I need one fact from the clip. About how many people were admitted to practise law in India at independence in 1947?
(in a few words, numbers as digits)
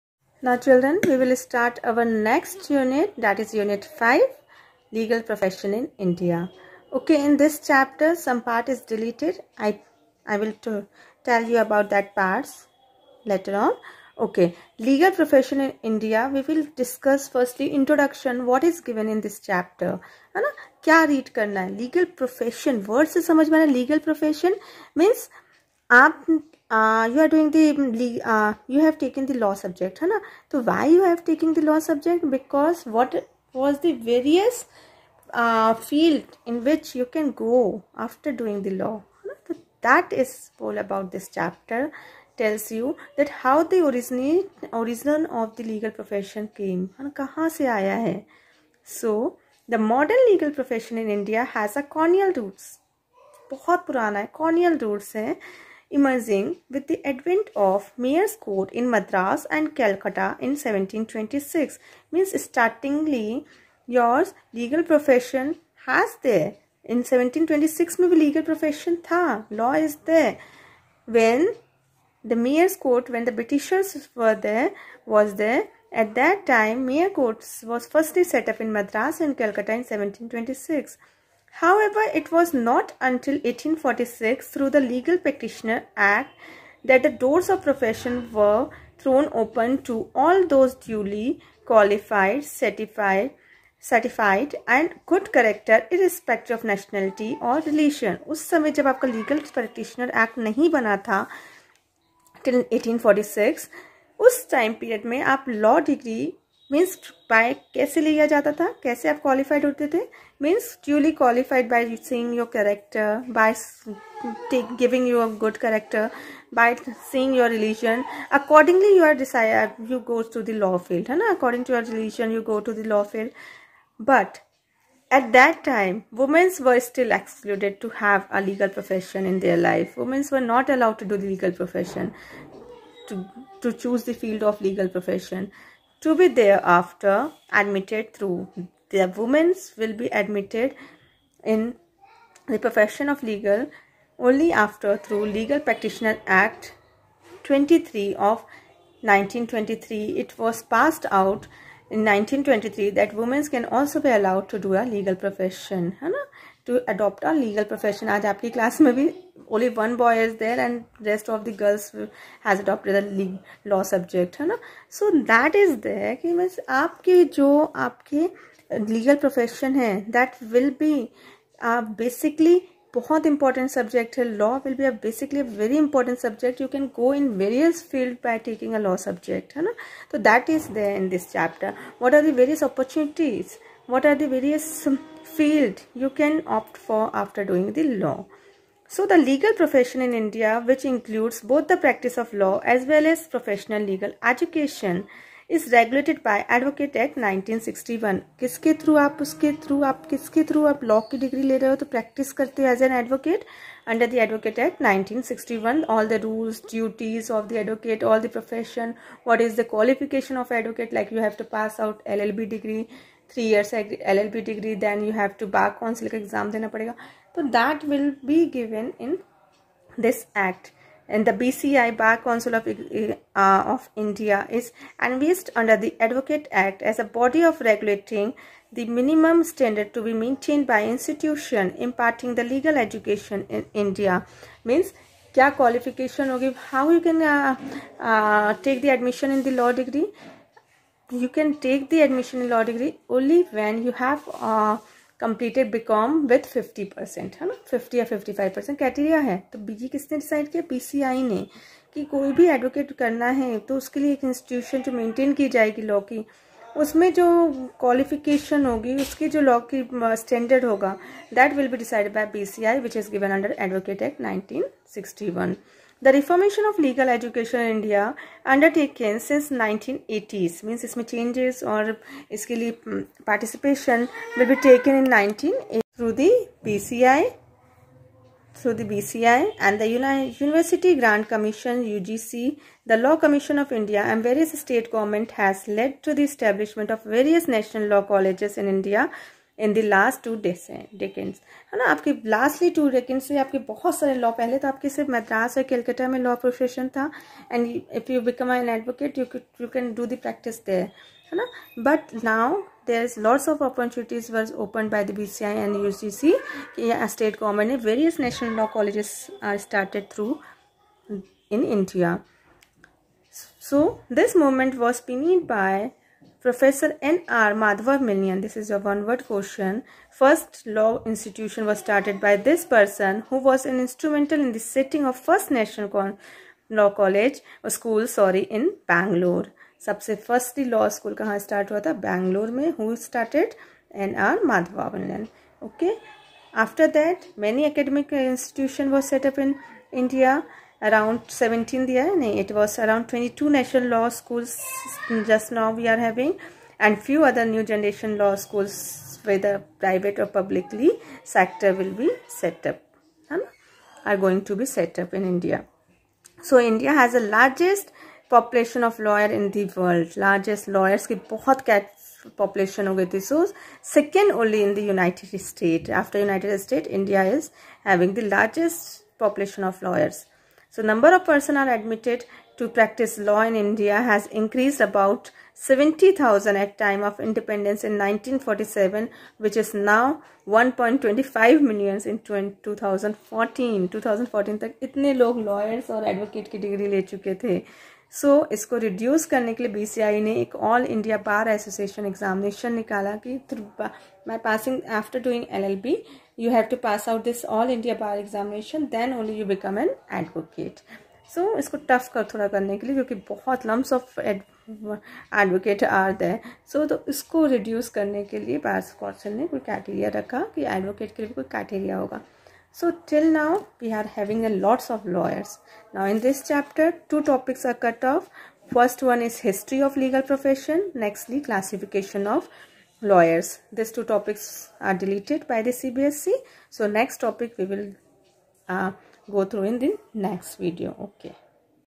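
70,000.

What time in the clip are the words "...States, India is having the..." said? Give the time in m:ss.
6:06.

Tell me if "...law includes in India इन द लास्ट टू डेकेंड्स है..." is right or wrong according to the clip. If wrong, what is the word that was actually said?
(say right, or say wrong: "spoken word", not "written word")
wrong: "colleges", not "includes".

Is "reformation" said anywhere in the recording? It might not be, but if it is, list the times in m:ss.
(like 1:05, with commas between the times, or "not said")
4:26.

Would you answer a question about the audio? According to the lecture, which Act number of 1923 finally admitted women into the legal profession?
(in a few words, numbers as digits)
Act 23.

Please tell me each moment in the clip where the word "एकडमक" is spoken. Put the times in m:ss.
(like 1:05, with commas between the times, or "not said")
5:37.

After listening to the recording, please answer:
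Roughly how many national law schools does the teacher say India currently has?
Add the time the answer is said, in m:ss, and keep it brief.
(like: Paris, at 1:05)
22, at 5:43.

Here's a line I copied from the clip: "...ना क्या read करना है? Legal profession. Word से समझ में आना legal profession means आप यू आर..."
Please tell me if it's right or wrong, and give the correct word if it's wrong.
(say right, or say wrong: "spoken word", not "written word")
right.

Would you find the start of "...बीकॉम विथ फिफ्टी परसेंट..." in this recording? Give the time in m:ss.
4:05.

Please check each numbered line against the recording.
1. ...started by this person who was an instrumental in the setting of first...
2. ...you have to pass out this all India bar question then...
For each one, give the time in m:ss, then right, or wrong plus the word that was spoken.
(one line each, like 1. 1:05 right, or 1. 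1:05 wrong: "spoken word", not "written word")
1. 5:21 right
2. 6:36 wrong: "examination", not "question".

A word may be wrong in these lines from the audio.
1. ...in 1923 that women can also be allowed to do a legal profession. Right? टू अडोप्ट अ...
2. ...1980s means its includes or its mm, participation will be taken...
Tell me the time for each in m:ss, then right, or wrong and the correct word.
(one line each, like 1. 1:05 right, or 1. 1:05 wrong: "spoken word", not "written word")
1. 2:31 right
2. 4:29 wrong: "changes", not "includes".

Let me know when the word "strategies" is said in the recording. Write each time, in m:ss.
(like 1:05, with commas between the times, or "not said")
not said.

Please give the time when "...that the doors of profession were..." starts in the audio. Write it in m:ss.
1:26.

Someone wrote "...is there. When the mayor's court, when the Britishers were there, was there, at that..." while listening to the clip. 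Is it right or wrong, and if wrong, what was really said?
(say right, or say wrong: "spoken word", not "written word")
right.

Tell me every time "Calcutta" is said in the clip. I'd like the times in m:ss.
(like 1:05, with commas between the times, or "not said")
0:59, 1:19.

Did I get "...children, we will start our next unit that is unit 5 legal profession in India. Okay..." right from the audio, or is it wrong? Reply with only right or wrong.
right.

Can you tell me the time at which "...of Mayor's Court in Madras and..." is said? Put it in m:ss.
0:57.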